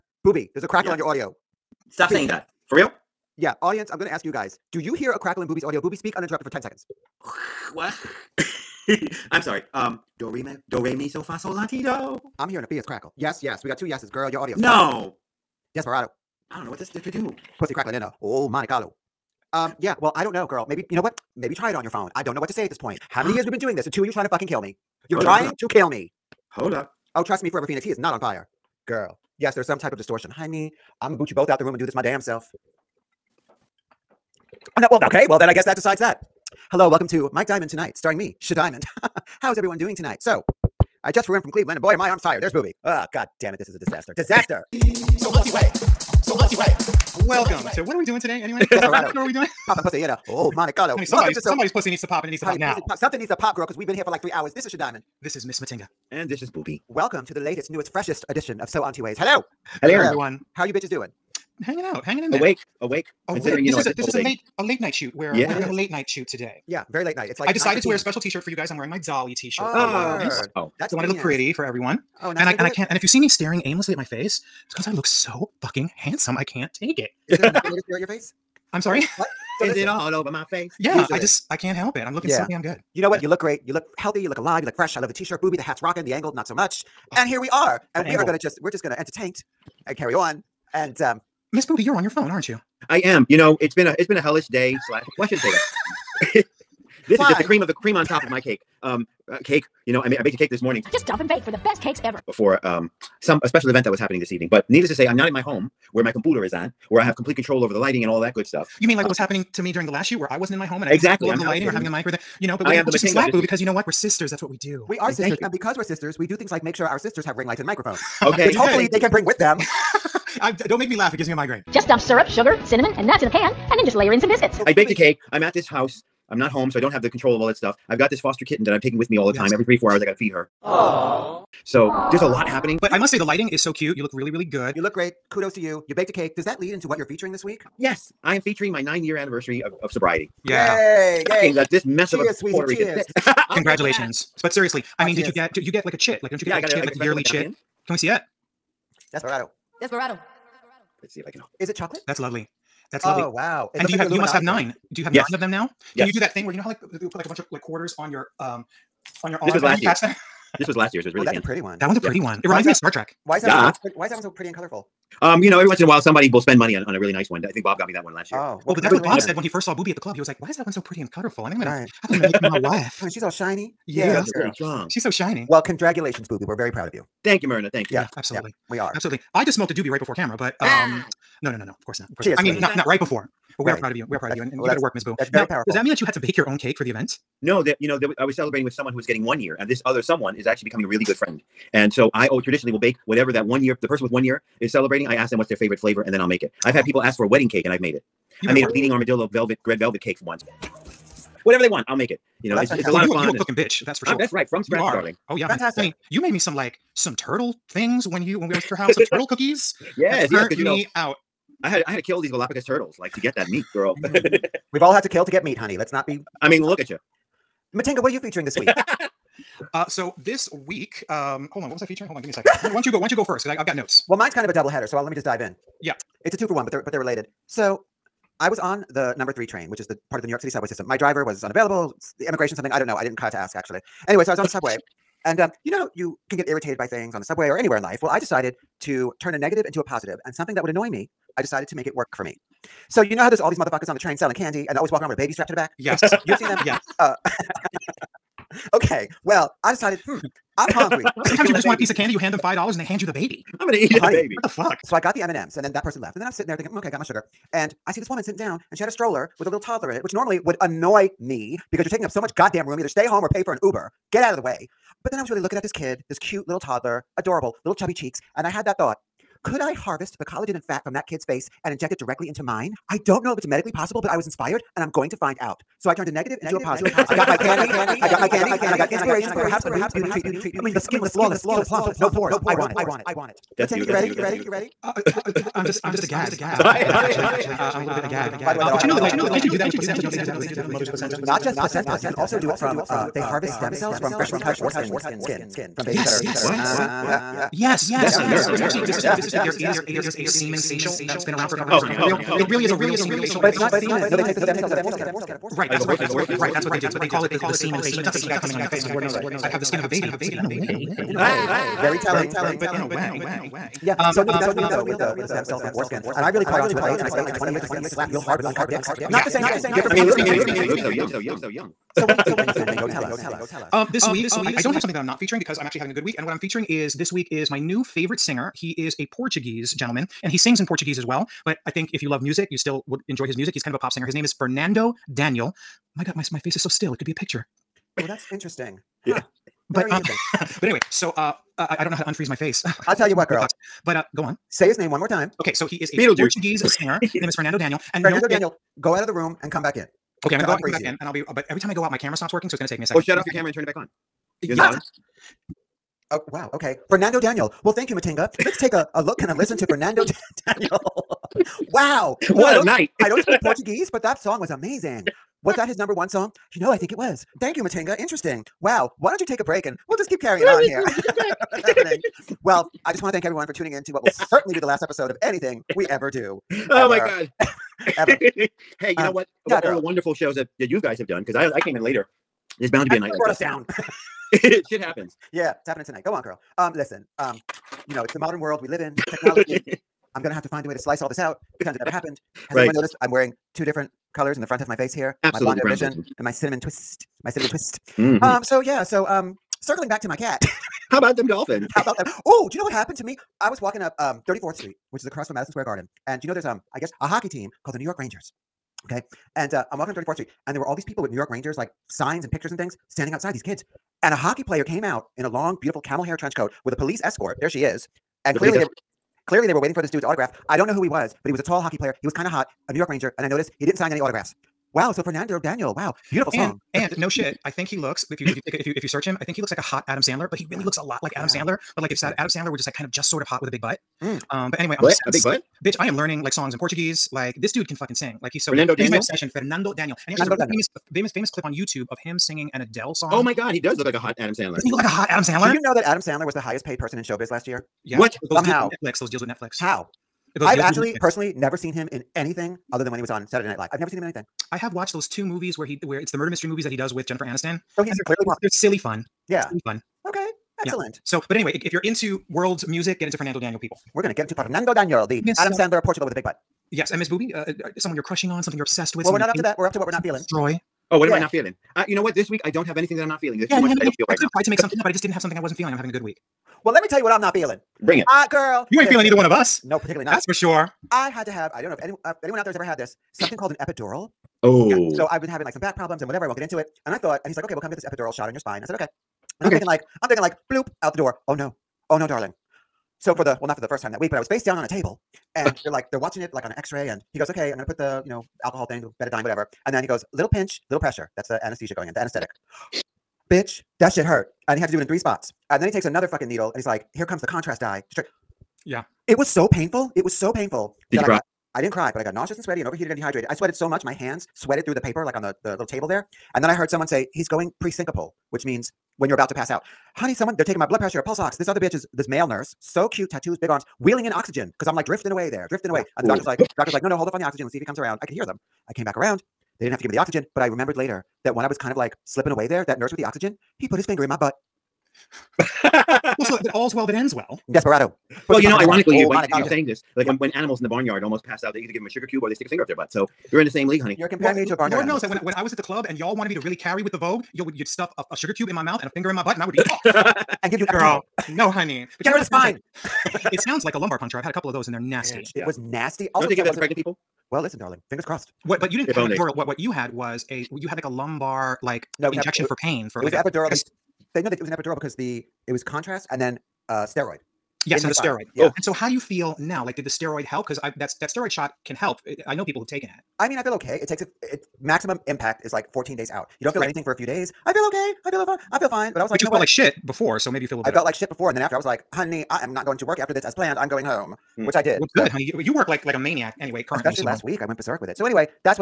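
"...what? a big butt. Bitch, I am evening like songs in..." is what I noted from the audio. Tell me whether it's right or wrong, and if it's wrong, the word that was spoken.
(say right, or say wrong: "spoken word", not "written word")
wrong: "learning", not "evening".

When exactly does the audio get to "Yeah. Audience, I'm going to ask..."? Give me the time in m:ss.
0:03.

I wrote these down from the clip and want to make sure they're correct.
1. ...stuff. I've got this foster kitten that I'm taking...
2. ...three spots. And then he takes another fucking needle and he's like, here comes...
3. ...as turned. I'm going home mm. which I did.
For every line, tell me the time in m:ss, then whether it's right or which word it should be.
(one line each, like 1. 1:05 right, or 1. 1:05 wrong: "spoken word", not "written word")
1. 2:07 right
2. 8:24 right
3. 9:43 wrong: "planned", not "turned".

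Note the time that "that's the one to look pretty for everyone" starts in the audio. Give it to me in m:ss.
1:10.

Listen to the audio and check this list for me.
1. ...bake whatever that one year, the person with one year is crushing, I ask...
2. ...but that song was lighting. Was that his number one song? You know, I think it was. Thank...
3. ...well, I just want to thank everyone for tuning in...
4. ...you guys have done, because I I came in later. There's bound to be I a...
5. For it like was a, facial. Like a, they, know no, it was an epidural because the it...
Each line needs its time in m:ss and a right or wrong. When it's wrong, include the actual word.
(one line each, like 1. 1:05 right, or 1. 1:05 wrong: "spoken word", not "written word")
1. 3:12 wrong: "celebrating", not "crushing"
2. 6:03 wrong: "amazing", not "lighting"
3. 6:12 right
4. 6:20 right
5. 9:22 wrong: "epidural", not "facial".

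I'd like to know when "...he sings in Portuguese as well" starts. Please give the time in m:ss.
5:30.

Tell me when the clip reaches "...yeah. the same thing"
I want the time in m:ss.
5:19.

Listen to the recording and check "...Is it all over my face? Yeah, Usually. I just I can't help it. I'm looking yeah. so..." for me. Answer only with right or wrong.
right.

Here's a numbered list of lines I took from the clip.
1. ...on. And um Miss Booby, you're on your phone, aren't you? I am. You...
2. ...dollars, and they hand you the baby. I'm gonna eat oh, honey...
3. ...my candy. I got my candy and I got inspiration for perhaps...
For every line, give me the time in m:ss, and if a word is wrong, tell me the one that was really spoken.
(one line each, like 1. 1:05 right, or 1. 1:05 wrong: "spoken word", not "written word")
1. 1:30 right
2. 4:12 right
3. 4:37 right.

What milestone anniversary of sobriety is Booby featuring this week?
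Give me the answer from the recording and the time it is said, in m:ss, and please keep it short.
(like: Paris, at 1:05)
9 year, at 2:18.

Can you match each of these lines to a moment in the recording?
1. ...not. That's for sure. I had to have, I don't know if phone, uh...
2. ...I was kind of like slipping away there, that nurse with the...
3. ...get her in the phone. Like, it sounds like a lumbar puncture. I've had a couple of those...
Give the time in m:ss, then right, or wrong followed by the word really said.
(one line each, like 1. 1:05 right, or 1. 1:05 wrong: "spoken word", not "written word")
1. 8:00 wrong: "anyone", not "phone"
2. 8:51 right
3. 9:12 wrong: "spine", not "phone".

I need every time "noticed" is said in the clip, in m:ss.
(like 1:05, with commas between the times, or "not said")
6:32, 7:03.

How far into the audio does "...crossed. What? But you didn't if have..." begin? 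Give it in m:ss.
9:18.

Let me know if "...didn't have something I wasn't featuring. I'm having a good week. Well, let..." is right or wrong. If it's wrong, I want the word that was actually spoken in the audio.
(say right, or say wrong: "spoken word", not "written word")
wrong: "feeling", not "featuring".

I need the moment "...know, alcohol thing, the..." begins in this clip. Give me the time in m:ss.
8:18.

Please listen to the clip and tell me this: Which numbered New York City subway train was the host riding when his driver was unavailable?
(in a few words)
3.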